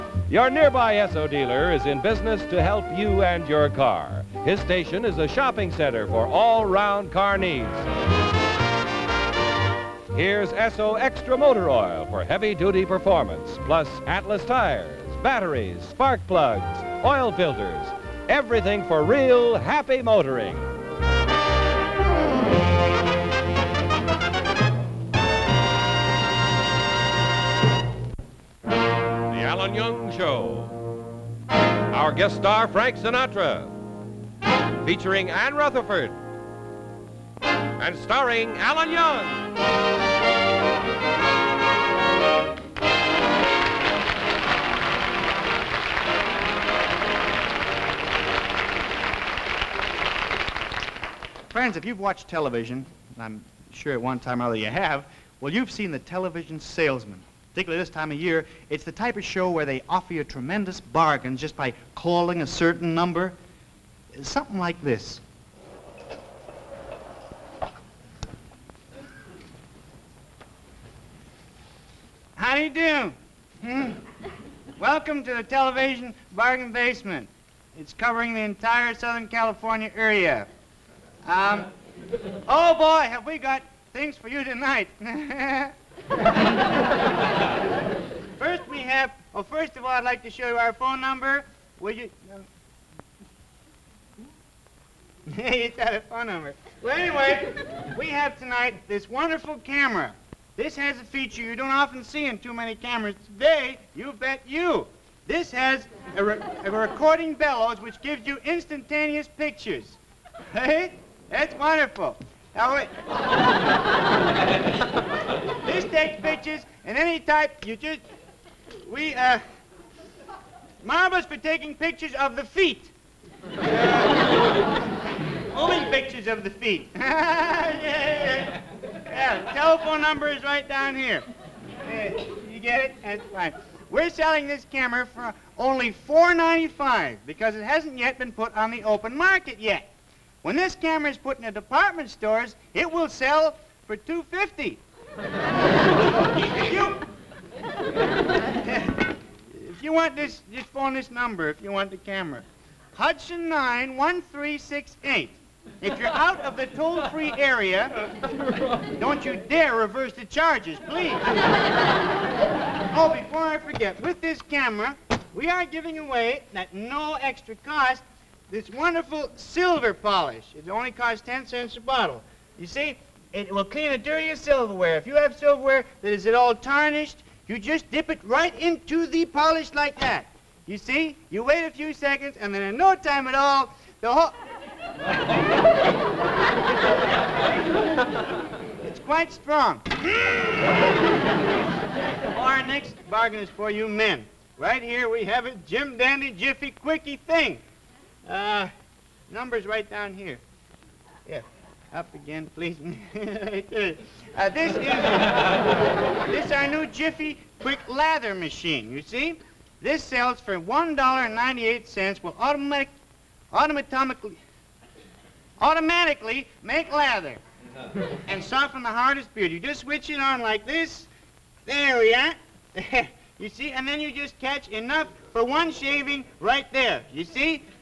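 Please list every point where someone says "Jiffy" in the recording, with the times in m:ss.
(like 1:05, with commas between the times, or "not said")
3:16, 3:26.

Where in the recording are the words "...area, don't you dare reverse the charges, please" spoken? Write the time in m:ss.
2:37.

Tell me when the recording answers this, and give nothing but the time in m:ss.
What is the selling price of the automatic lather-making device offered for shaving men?
3:30.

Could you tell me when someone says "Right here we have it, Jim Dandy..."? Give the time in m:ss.
3:14.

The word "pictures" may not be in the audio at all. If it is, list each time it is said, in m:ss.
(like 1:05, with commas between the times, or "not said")
1:49, 1:56, 2:01, 2:05.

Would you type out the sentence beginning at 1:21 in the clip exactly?
Um, oh boy, have we got things for you tonight.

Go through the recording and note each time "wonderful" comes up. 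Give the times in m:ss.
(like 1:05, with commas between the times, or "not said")
1:39, 1:51, 2:48.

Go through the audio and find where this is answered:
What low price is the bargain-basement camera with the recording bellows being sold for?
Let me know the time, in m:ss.
2:16.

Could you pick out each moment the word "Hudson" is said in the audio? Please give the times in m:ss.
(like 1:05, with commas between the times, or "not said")
2:32.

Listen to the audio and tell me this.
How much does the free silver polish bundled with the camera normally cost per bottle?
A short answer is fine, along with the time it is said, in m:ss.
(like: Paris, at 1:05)
10 cents, at 2:51.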